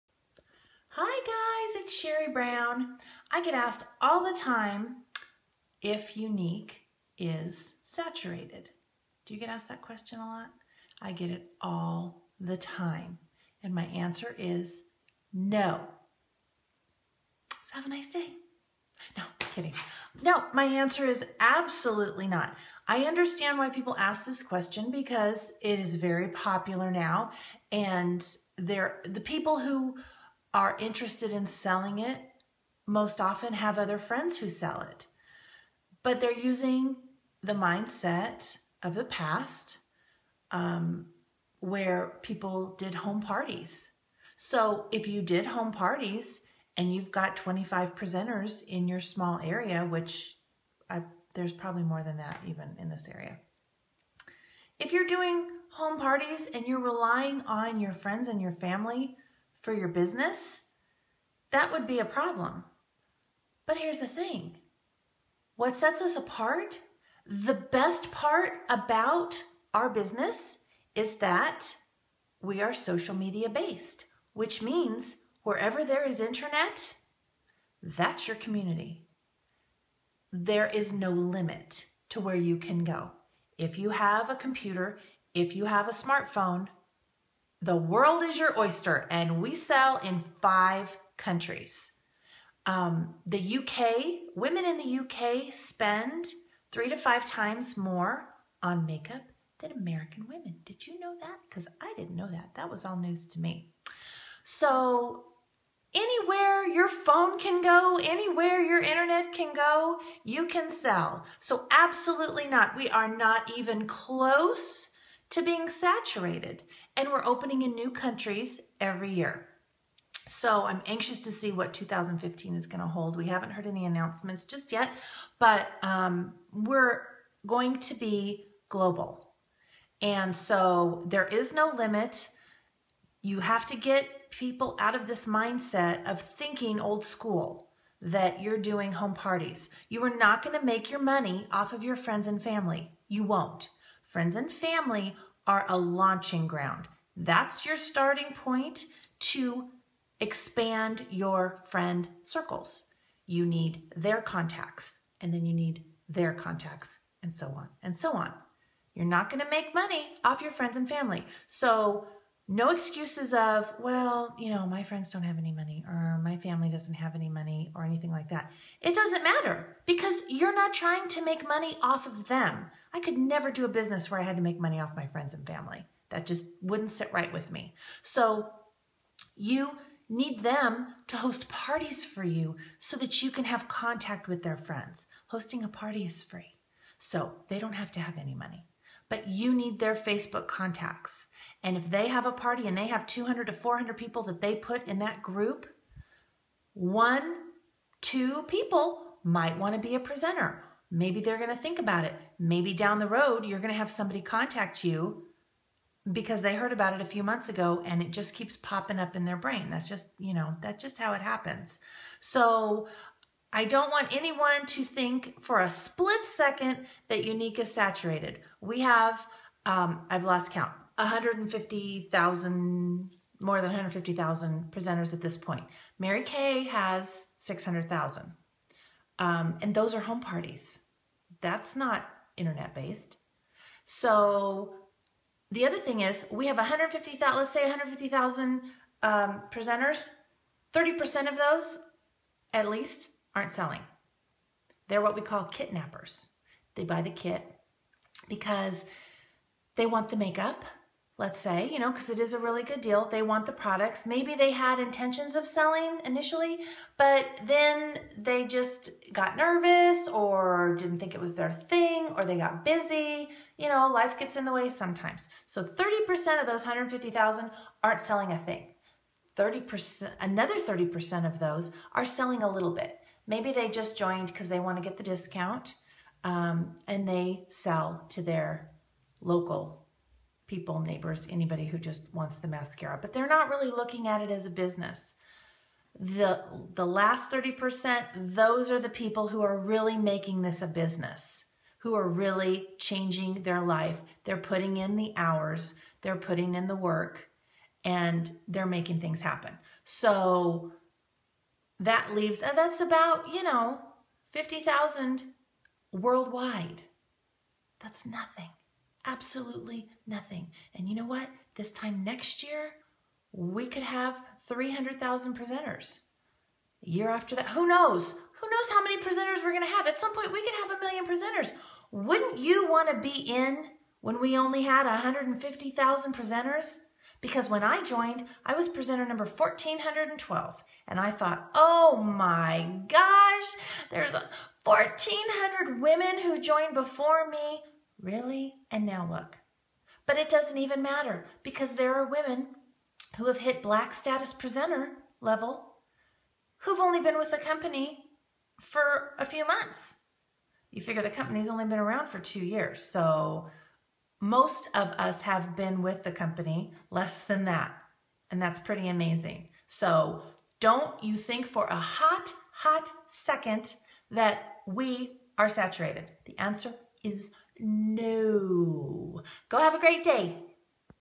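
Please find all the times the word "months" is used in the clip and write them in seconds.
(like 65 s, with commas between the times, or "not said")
207 s, 349 s.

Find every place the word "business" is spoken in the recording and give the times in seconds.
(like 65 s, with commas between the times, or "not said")
59 s, 69 s, 173 s, 284 s, 290 s.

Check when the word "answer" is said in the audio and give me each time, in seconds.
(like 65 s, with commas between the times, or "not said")
13 s, 20 s, 366 s.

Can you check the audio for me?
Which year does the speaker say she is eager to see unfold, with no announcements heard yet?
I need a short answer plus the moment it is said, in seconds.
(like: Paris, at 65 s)
2015, at 121 s.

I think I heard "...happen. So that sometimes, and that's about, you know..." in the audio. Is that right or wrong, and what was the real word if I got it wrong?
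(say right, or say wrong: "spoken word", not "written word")
wrong: "leaves", not "sometimes".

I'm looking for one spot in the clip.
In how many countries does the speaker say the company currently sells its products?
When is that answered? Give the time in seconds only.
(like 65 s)
90 s.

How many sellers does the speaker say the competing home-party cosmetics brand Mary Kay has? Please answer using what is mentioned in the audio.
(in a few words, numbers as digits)
600,000.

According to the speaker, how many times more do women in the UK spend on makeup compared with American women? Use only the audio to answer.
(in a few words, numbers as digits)
3 to 5 times.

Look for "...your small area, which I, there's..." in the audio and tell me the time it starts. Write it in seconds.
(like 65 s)
48 s.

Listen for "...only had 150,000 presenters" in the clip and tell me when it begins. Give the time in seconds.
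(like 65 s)
324 s.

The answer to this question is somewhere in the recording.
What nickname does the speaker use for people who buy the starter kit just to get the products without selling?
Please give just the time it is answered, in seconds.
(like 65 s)
245 s.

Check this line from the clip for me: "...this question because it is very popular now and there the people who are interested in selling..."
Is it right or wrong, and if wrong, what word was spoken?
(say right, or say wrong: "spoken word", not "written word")
right.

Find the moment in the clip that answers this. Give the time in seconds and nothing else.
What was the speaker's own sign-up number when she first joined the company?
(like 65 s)
329 s.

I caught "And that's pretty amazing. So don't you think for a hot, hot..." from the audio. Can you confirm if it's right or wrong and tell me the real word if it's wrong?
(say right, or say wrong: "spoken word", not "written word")
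right.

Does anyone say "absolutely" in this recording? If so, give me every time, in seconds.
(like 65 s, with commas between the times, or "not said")
21 s, 111 s, 309 s.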